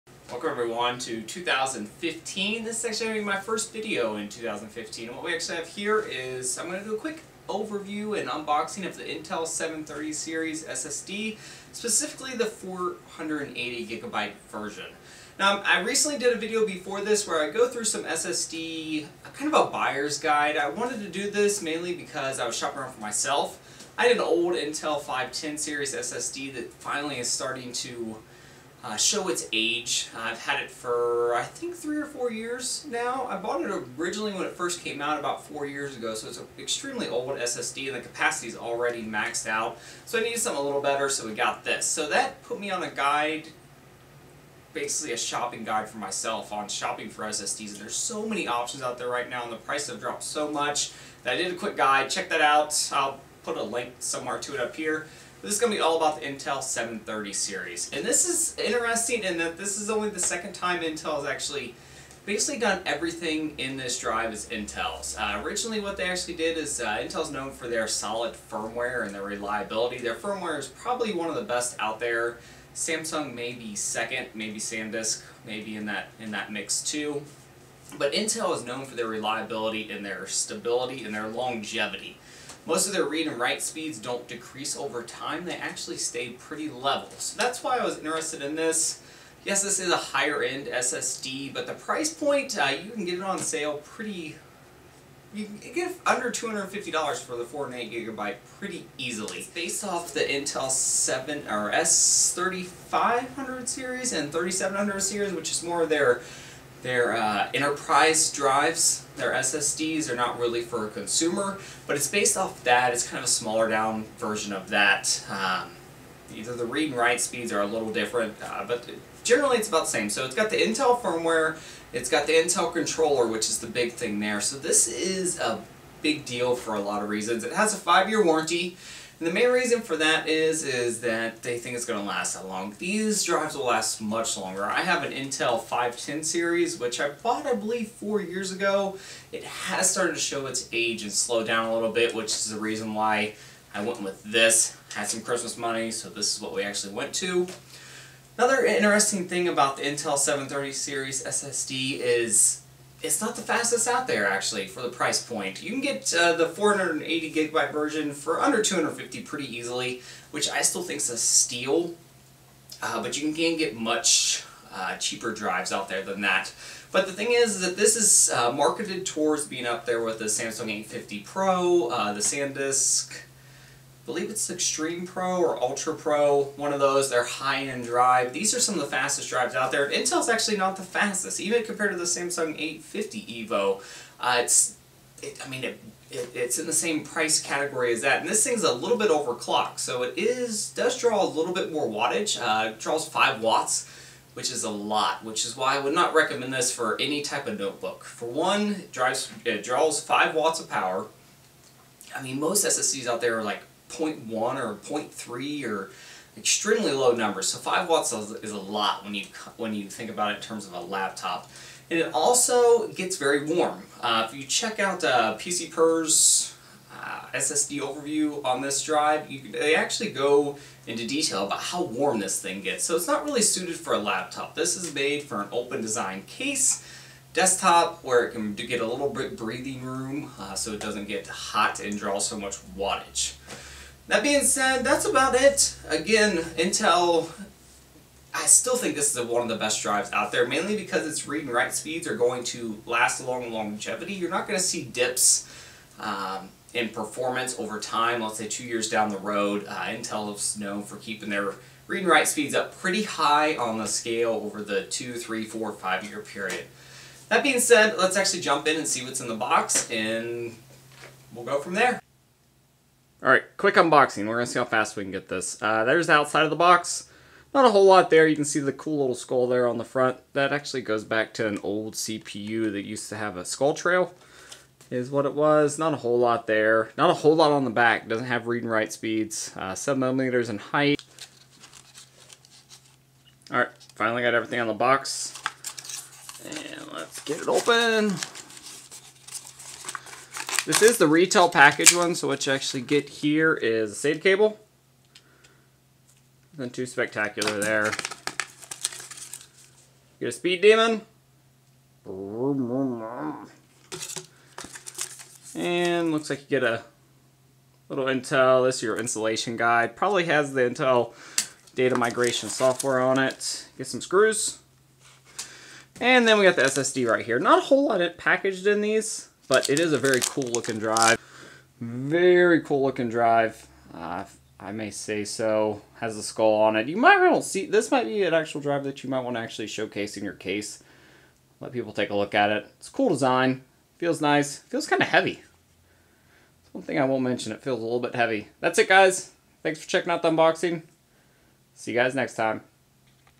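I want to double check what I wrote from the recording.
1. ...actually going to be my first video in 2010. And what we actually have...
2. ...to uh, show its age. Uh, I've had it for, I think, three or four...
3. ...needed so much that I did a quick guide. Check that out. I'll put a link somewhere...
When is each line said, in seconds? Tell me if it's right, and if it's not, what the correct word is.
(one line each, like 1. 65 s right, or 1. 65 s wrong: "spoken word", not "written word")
1. 2 s wrong: "2015", not "2010"
2. 27 s right
3. 49 s wrong: "dropped", not "needed".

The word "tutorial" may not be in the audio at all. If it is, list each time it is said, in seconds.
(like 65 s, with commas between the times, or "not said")
not said.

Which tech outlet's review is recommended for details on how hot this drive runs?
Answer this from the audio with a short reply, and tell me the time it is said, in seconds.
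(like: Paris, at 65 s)
PC Per, at 215 s.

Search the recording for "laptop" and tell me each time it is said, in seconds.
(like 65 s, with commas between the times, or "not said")
210 s, 223 s.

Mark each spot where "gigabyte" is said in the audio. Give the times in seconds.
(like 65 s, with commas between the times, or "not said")
13 s, 97 s, 157 s.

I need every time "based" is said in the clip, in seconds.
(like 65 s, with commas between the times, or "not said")
99 s, 112 s.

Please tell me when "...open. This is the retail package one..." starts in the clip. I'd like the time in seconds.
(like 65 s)
287 s.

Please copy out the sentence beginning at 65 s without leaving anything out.
Uh, originally what they actually did is uh, Intel's known for their solid firmware and their reliability.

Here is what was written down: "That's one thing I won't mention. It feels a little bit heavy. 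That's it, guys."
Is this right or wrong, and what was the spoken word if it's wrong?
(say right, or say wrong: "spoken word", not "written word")
right.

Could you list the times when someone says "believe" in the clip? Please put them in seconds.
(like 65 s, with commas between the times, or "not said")
137 s, 174 s.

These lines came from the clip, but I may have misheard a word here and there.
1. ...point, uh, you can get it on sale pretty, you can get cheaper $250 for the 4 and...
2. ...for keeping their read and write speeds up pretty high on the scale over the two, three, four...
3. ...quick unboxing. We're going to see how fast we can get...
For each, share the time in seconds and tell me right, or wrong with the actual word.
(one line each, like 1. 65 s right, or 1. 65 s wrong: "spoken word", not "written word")
1. 92 s wrong: "under", not "cheaper"
2. 250 s right
3. 263 s right.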